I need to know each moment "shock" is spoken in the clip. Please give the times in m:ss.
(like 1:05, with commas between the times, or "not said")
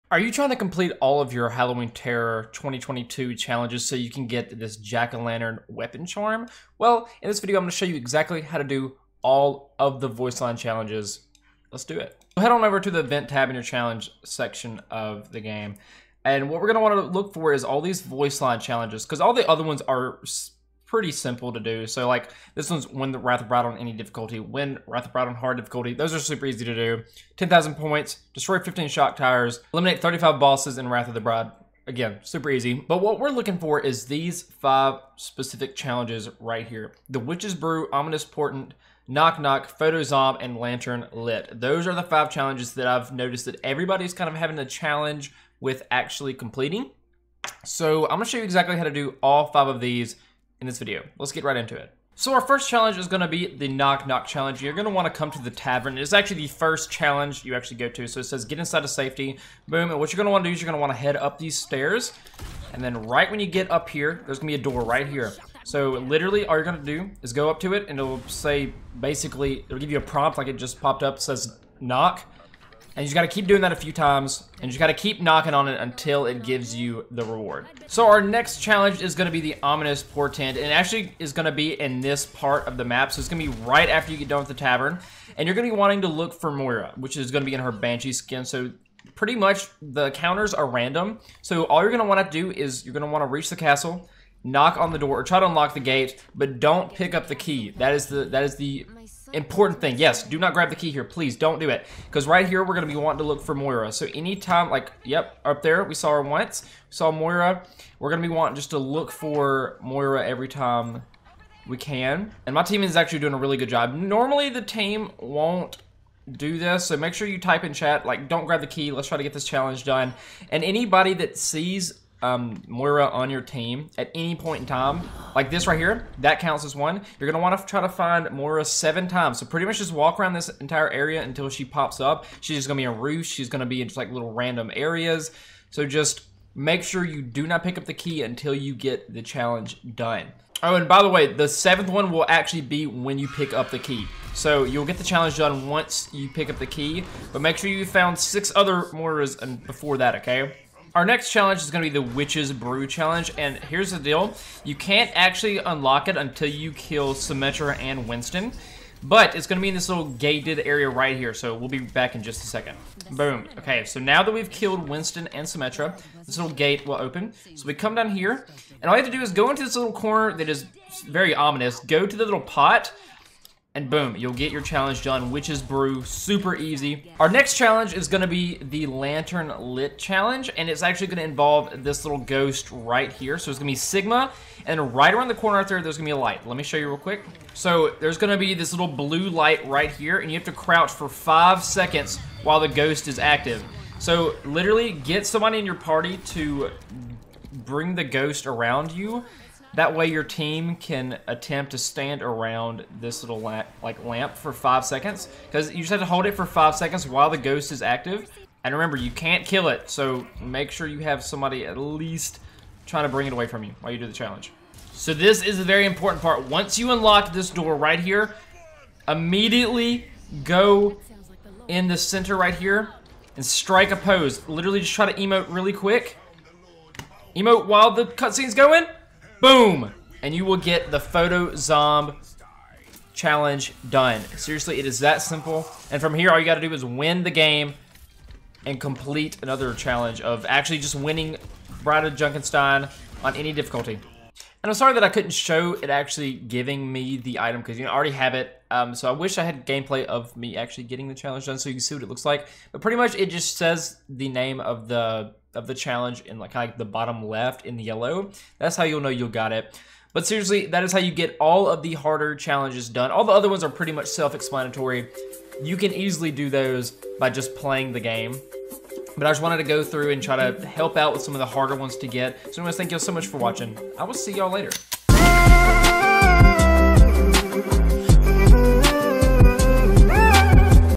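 0:28.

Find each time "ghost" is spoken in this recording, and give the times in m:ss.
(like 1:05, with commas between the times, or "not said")
3:02, 3:12, 3:18, 3:27.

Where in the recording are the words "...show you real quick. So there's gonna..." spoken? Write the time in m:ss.
3:06.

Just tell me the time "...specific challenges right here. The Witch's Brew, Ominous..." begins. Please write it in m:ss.
0:35.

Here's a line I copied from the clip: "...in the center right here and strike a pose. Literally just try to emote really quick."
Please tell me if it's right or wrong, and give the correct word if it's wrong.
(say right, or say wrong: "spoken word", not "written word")
right.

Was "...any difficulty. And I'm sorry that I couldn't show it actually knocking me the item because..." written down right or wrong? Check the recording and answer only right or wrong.
wrong.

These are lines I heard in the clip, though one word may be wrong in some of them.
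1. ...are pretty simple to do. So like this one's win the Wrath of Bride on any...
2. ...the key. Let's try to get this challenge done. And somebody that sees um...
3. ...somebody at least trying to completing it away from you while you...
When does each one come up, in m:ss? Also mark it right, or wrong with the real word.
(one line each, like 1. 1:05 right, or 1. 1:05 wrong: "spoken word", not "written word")
1. 0:19 right
2. 1:58 wrong: "anybody", not "somebody"
3. 3:31 wrong: "bring", not "completing".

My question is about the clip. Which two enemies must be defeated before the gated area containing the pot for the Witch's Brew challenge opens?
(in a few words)
Symmetra and Winston.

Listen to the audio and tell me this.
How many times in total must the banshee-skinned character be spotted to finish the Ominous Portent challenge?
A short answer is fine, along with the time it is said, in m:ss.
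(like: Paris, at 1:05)
7, at 2:08.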